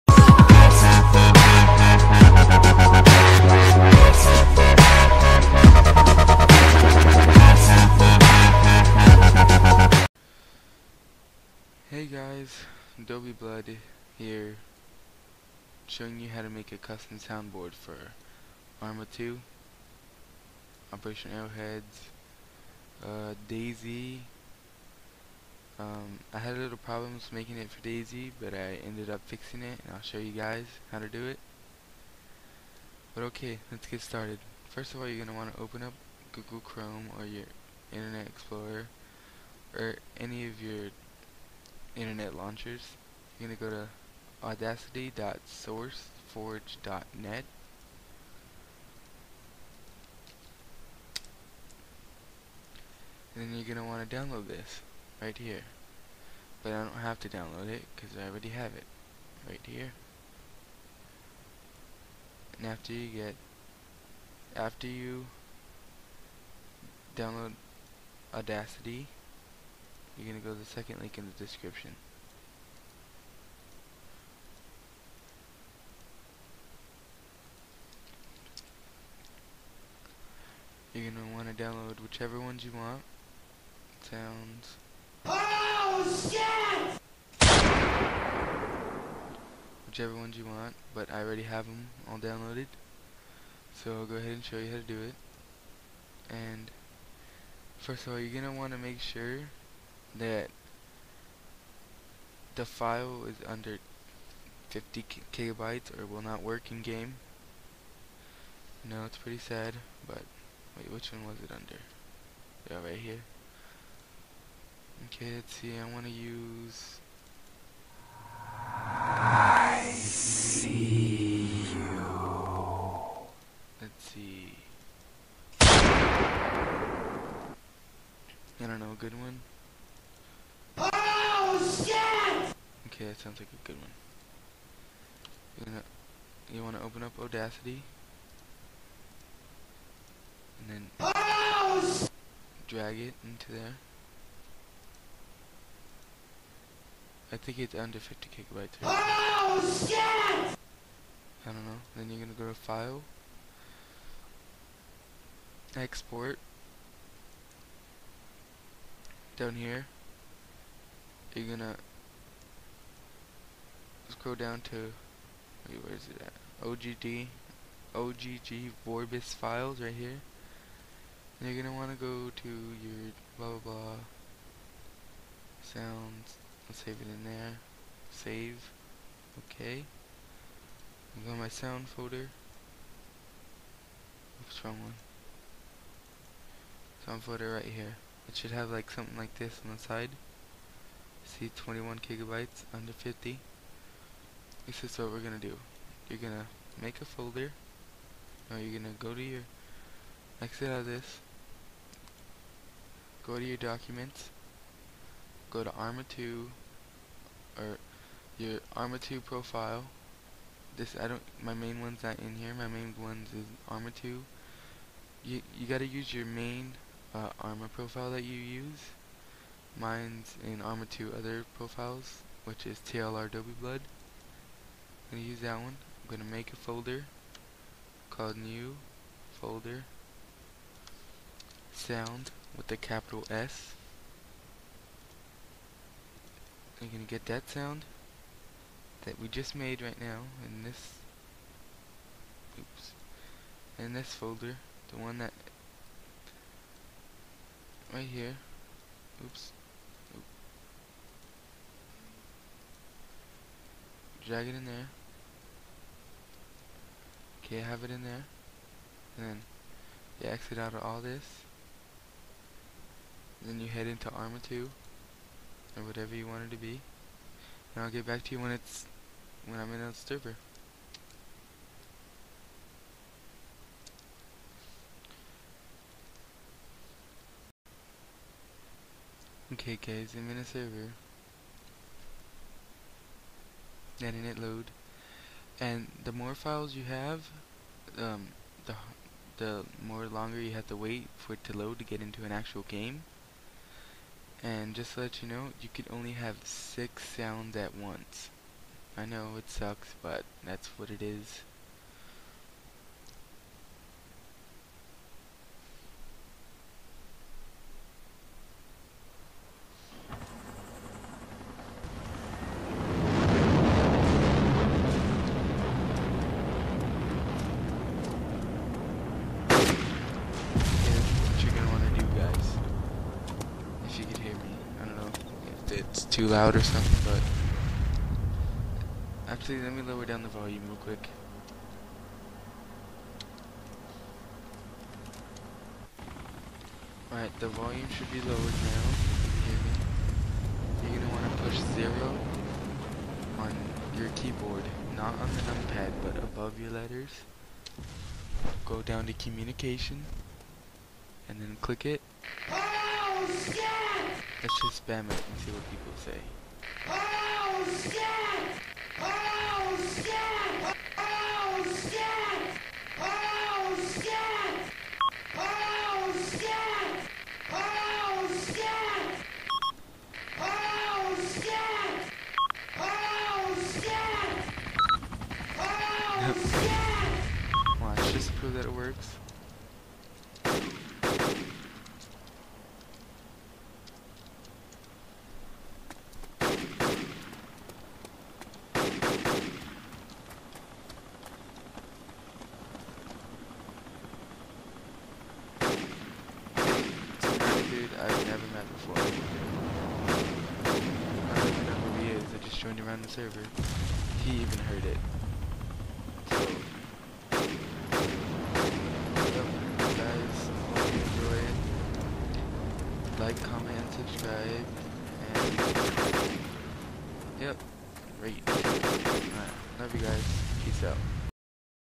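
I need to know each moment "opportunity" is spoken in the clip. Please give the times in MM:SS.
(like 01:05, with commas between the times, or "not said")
not said.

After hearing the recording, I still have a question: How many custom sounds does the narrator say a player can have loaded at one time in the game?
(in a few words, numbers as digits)
6.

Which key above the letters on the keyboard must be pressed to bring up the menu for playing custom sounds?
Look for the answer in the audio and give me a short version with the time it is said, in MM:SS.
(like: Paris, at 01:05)
0, at 05:41.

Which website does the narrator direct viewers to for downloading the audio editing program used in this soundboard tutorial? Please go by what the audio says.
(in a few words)
audacity.sourceforge.net.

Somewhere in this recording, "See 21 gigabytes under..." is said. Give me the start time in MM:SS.
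03:11.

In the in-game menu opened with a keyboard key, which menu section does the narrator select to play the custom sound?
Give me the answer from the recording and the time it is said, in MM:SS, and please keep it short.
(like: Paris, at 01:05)
communication, at 05:49.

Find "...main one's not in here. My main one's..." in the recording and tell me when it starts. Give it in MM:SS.
03:31.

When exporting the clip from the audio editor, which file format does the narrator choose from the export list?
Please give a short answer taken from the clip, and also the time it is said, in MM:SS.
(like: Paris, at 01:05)
OGG Vorbis, at 02:47.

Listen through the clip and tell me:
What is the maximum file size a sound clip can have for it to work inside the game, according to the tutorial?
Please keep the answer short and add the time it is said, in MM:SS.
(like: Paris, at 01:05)
50 kilobytes, at 01:44.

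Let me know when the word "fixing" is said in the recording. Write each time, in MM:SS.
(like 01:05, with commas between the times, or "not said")
00:29.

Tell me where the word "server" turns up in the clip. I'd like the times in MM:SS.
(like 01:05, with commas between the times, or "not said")
04:29, 04:40, 06:43.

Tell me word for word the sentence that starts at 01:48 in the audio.
No, it's pretty sad, but wait, which one was it under?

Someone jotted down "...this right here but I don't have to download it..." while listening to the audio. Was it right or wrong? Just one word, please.
right.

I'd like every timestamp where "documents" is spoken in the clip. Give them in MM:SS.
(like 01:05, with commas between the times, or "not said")
03:23.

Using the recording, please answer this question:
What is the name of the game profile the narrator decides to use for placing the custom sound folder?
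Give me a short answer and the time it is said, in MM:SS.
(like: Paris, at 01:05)
TLRW Blood, at 03:42.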